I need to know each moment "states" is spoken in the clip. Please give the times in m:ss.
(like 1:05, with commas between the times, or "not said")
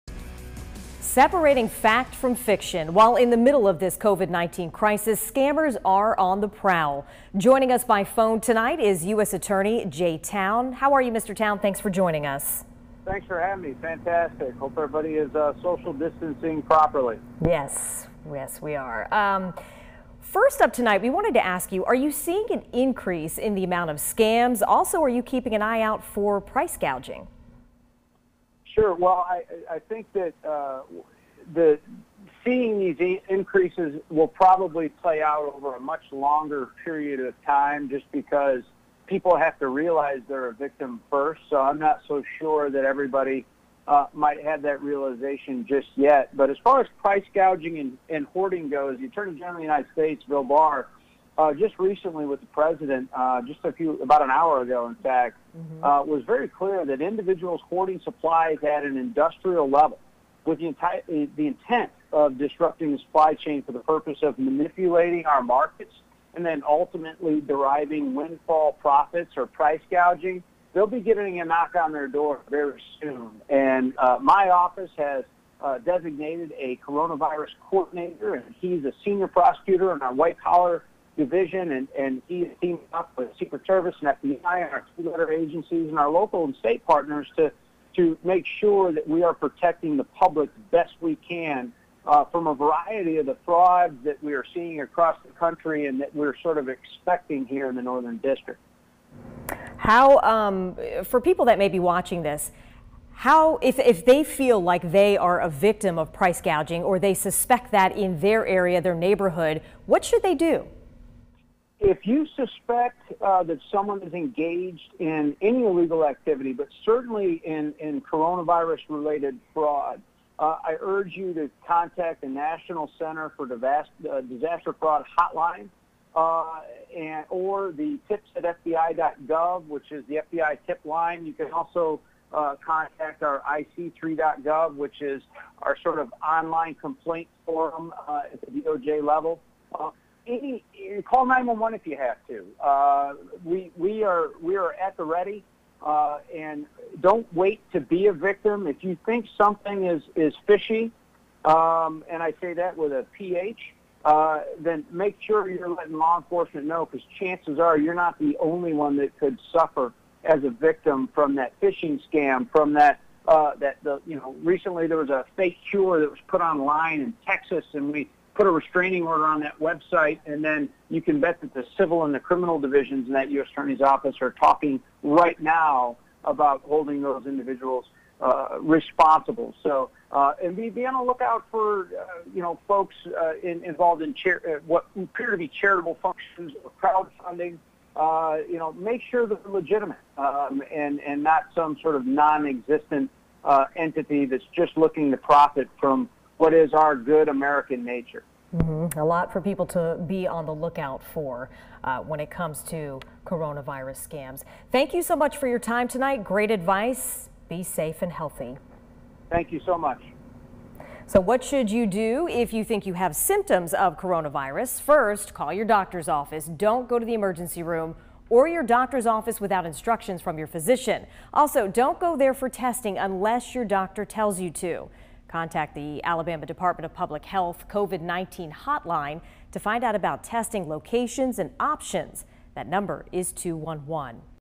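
0:49, 1:26.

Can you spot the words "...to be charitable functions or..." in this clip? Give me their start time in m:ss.
3:05.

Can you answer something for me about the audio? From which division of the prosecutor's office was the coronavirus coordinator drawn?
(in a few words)
white collar division.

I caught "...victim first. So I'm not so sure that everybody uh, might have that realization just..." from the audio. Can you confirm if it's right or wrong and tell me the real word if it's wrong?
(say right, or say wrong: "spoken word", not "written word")
right.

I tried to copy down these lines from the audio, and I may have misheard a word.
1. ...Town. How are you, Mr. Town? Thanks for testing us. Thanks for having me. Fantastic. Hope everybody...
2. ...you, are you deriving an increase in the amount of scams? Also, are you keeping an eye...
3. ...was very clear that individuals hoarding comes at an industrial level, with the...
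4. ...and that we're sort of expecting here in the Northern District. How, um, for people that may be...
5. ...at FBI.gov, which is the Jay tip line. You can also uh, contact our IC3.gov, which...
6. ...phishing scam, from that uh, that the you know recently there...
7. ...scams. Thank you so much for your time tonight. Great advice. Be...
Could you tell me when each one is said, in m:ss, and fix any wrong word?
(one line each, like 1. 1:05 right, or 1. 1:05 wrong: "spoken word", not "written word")
1. 0:10 wrong: "joining", not "testing"
2. 0:21 wrong: "seeing", not "deriving"
3. 0:56 wrong: "supplies", not "comes"
4. 1:35 right
5. 2:08 wrong: "FBI", not "Jay"
6. 2:41 right
7. 3:24 right.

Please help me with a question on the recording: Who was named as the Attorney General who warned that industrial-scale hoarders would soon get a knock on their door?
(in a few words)
Bill Barr.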